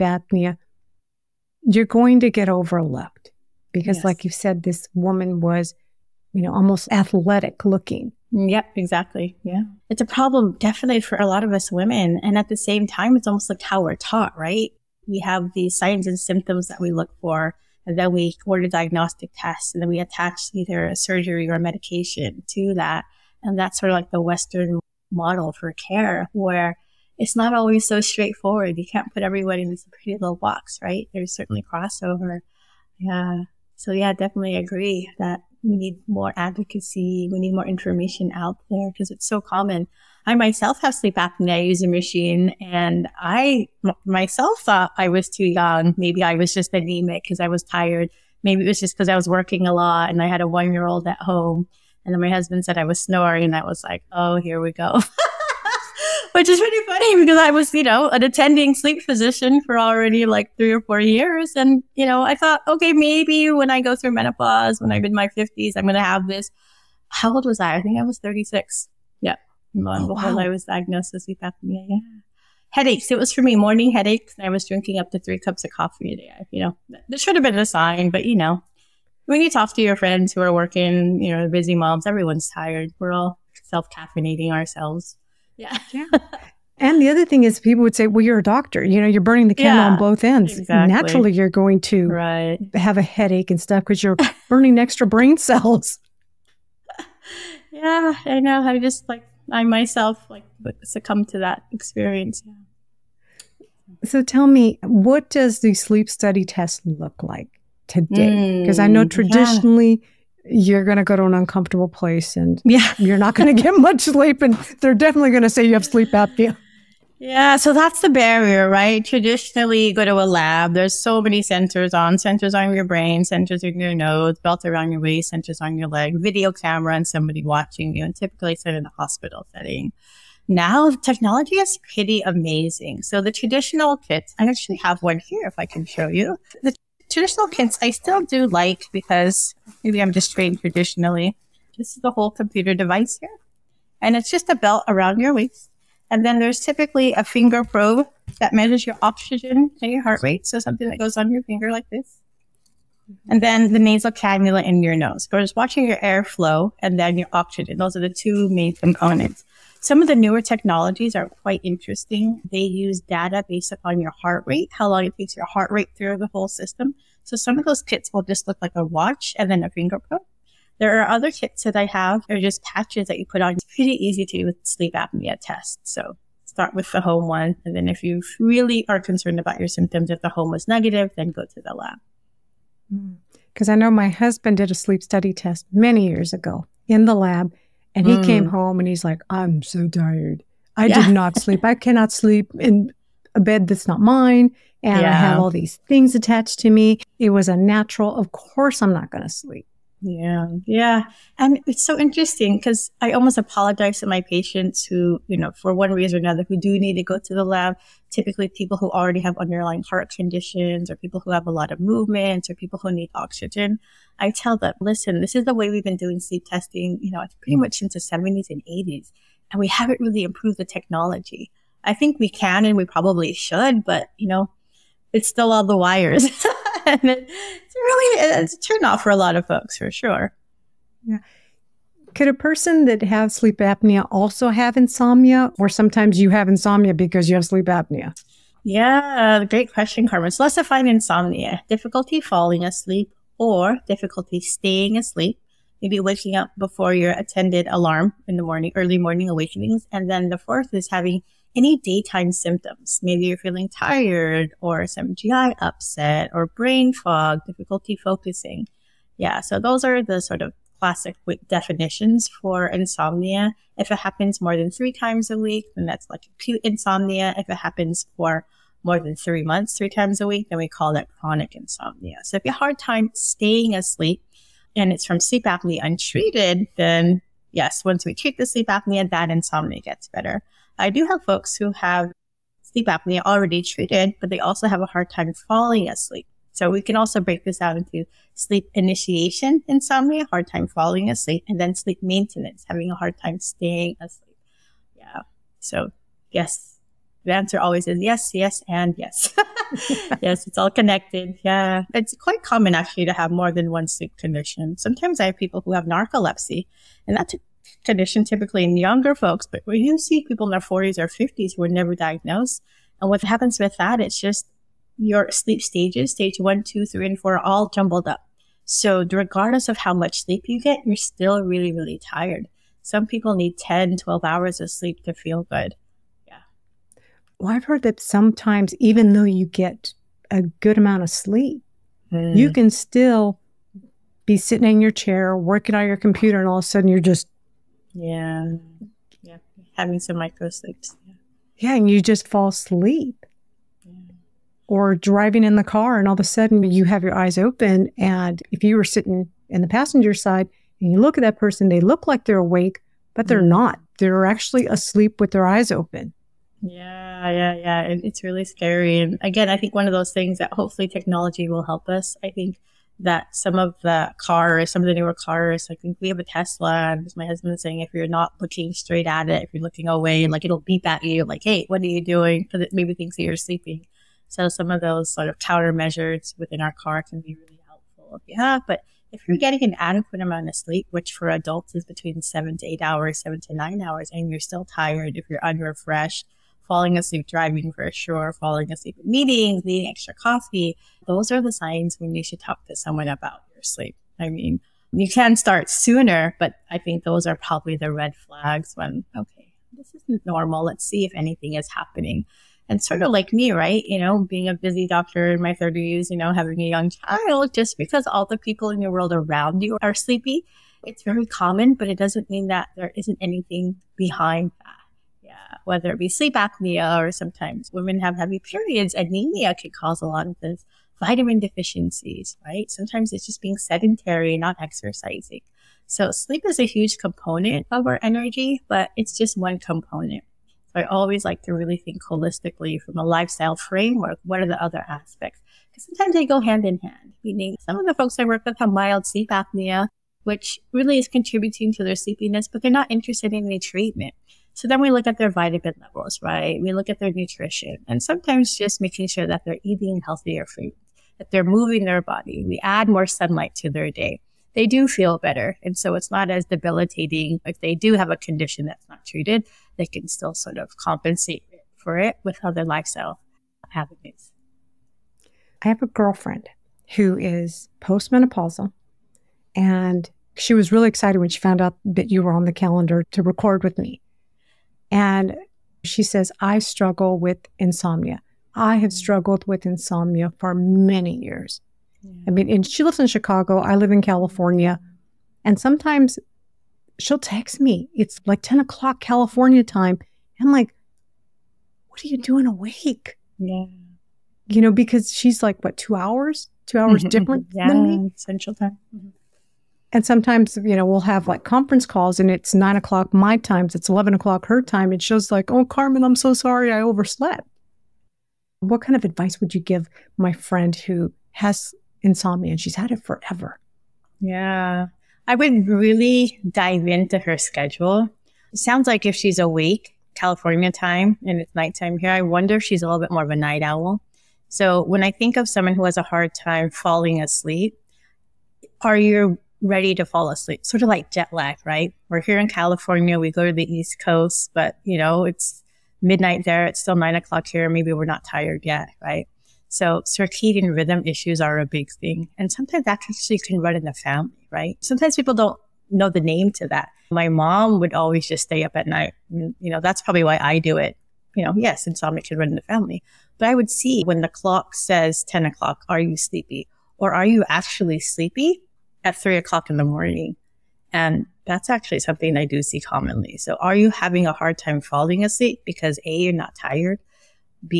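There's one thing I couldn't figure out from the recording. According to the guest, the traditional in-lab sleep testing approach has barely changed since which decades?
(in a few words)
70s and 80s.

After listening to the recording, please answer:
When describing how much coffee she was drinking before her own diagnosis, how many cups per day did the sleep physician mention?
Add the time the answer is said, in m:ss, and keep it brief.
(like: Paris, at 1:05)
3, at 1:15.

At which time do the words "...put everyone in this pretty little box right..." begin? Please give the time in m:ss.
0:29.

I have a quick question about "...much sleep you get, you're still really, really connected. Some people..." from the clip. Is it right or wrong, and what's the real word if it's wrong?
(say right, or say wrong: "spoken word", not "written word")
wrong: "tired", not "connected".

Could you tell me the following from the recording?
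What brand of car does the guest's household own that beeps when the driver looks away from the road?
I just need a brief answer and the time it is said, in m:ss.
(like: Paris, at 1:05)
Tesla, at 6:06.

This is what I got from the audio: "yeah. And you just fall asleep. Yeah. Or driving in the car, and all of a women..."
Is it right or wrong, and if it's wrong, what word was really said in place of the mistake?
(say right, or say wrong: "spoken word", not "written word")
wrong: "sudden", not "women".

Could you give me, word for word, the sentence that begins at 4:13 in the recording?
Maybe you're feeling tired or some GI upset or brain fog, difficulty focusing.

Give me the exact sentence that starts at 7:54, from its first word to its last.
And she says, I struggle with insomnia.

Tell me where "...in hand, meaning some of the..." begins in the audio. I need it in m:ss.
7:16.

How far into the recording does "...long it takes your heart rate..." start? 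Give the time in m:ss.
2:44.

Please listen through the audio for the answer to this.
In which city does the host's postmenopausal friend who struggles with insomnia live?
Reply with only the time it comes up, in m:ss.
8:03.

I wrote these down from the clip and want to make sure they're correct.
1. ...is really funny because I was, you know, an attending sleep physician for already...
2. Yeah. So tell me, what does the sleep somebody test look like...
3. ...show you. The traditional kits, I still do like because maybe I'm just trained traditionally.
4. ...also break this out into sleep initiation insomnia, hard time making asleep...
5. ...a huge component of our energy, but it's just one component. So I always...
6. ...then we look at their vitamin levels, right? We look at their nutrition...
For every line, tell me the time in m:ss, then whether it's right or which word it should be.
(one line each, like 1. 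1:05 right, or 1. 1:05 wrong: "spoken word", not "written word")
1. 0:56 right
2. 1:42 wrong: "study", not "somebody"
3. 2:15 right
4. 4:46 wrong: "falling", not "making"
5. 7:06 right
6. 7:24 right.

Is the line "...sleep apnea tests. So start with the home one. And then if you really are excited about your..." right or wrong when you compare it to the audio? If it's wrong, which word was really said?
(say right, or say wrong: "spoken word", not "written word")
wrong: "concerned", not "excited".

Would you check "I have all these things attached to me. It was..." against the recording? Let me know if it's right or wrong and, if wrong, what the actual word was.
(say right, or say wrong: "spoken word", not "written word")
right.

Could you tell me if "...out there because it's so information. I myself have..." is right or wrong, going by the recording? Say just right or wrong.
wrong.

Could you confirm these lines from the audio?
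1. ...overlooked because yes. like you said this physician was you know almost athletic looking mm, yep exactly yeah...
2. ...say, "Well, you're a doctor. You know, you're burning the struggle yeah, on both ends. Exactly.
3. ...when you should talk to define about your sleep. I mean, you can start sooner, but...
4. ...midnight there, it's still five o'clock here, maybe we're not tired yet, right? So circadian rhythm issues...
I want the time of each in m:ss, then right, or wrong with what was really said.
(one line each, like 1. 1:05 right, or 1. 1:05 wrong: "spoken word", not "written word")
1. 0:02 wrong: "woman", not "physician"
2. 1:27 wrong: "candle", not "struggle"
3. 6:31 wrong: "someone", not "define"
4. 8:56 wrong: "nine", not "five".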